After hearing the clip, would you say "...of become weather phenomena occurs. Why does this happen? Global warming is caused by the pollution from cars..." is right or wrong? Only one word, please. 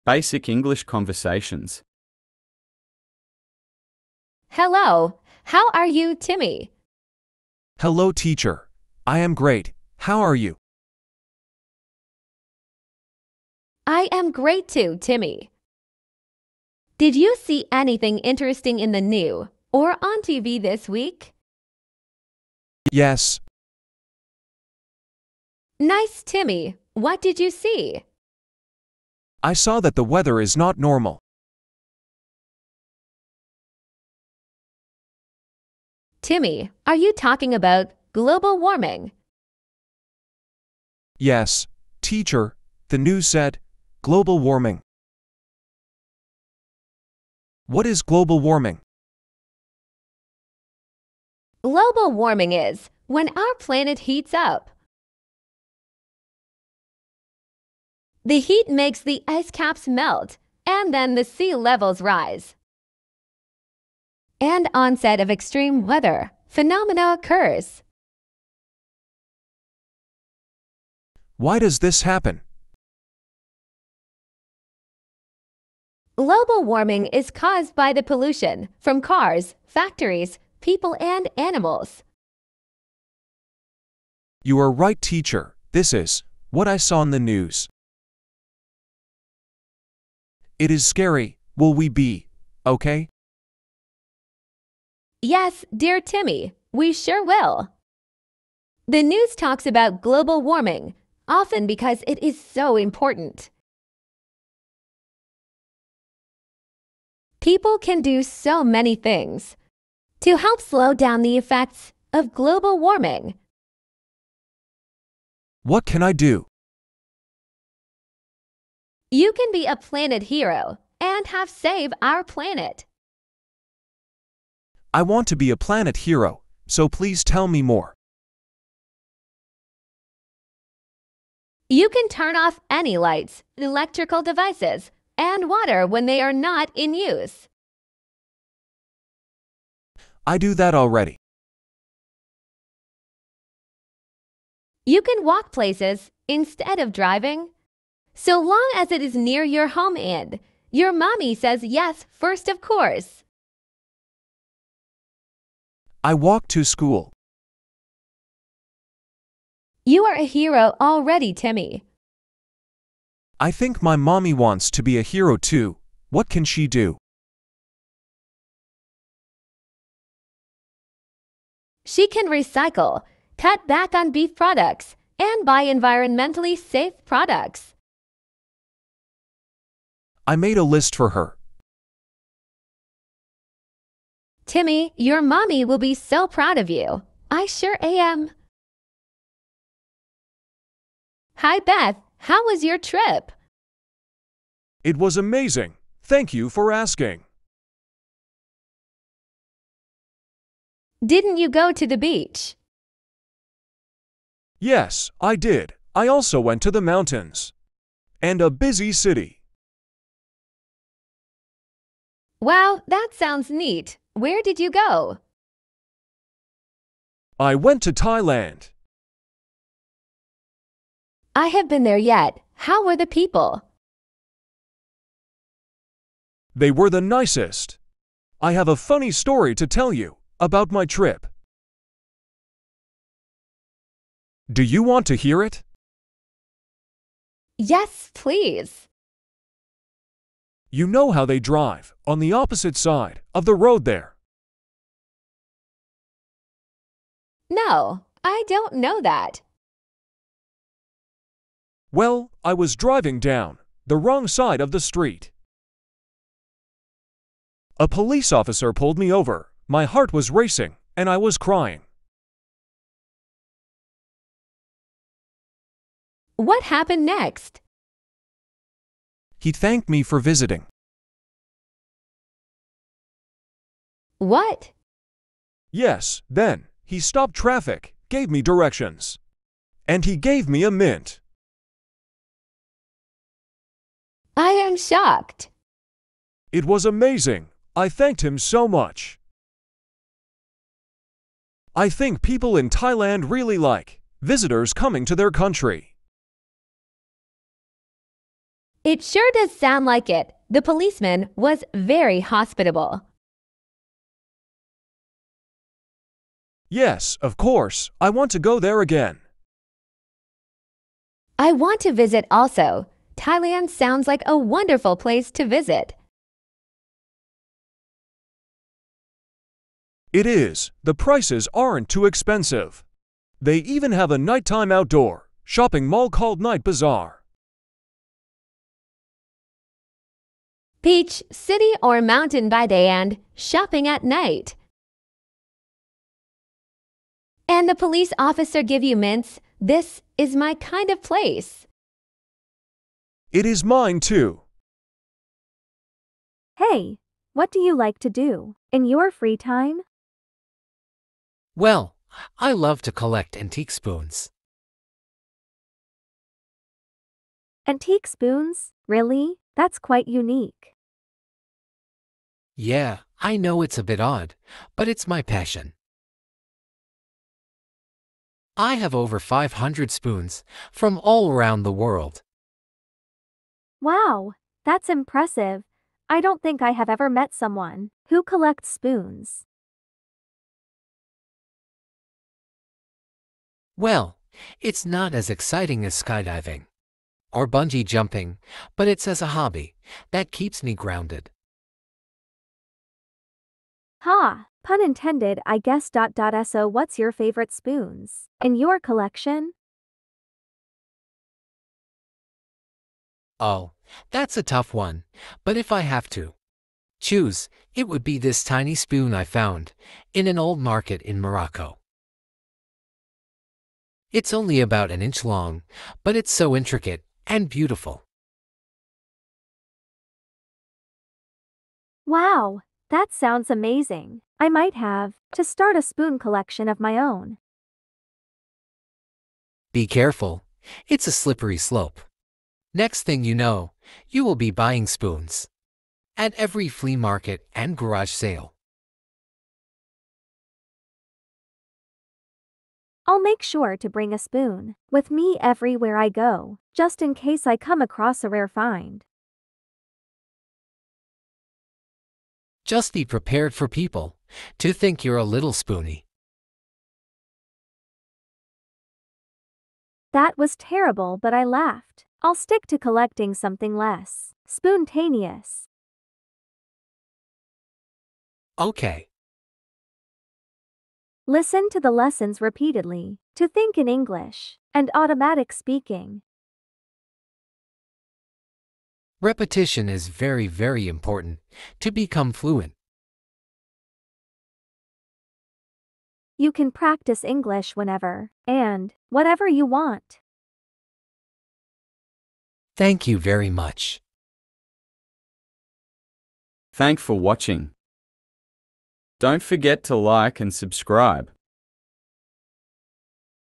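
wrong.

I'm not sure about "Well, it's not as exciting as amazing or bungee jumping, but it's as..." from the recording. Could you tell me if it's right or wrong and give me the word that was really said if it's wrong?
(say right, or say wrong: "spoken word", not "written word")
wrong: "skydiving", not "amazing".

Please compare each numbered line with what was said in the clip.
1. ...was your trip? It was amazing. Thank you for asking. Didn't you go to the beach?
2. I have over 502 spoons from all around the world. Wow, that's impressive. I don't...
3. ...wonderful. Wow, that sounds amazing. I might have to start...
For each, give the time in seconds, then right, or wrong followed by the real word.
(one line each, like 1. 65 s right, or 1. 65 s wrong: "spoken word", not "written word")
1. 192 s right
2. 368 s wrong: "500", not "502"
3. 417 s wrong: "beautiful", not "wonderful".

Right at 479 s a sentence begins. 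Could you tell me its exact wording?
Repetition is very, very important to become fluent.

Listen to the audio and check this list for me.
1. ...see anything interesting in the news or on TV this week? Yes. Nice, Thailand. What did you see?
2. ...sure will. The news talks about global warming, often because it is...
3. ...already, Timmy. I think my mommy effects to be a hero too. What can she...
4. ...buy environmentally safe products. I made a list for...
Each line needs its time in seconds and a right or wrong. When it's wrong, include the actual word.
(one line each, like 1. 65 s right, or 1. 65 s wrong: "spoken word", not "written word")
1. 17 s wrong: "Timmy", not "Thailand"
2. 96 s right
3. 160 s wrong: "wants", not "effects"
4. 175 s right.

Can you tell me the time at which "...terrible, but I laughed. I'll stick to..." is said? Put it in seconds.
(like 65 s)
460 s.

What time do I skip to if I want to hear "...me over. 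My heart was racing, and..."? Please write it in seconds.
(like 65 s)
258 s.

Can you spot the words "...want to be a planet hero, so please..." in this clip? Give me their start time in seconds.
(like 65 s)
125 s.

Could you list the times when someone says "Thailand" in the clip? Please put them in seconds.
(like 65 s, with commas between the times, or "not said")
217 s, 292 s, 313 s.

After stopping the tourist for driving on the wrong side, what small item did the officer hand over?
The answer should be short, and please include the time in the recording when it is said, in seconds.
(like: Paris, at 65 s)
A mint, at 280 s.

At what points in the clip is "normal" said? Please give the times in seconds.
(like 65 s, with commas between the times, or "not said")
30 s.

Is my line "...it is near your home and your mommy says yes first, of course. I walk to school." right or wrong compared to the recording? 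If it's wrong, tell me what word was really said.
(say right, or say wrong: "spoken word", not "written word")
right.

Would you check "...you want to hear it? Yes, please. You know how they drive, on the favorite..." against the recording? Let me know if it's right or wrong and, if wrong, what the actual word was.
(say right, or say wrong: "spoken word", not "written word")
wrong: "opposite", not "favorite".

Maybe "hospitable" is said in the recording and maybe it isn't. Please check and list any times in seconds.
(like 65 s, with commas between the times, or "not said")
302 s.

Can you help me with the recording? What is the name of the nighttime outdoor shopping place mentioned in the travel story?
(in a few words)
Night Bazaar.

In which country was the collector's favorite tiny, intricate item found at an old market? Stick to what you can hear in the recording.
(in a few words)
Morocco.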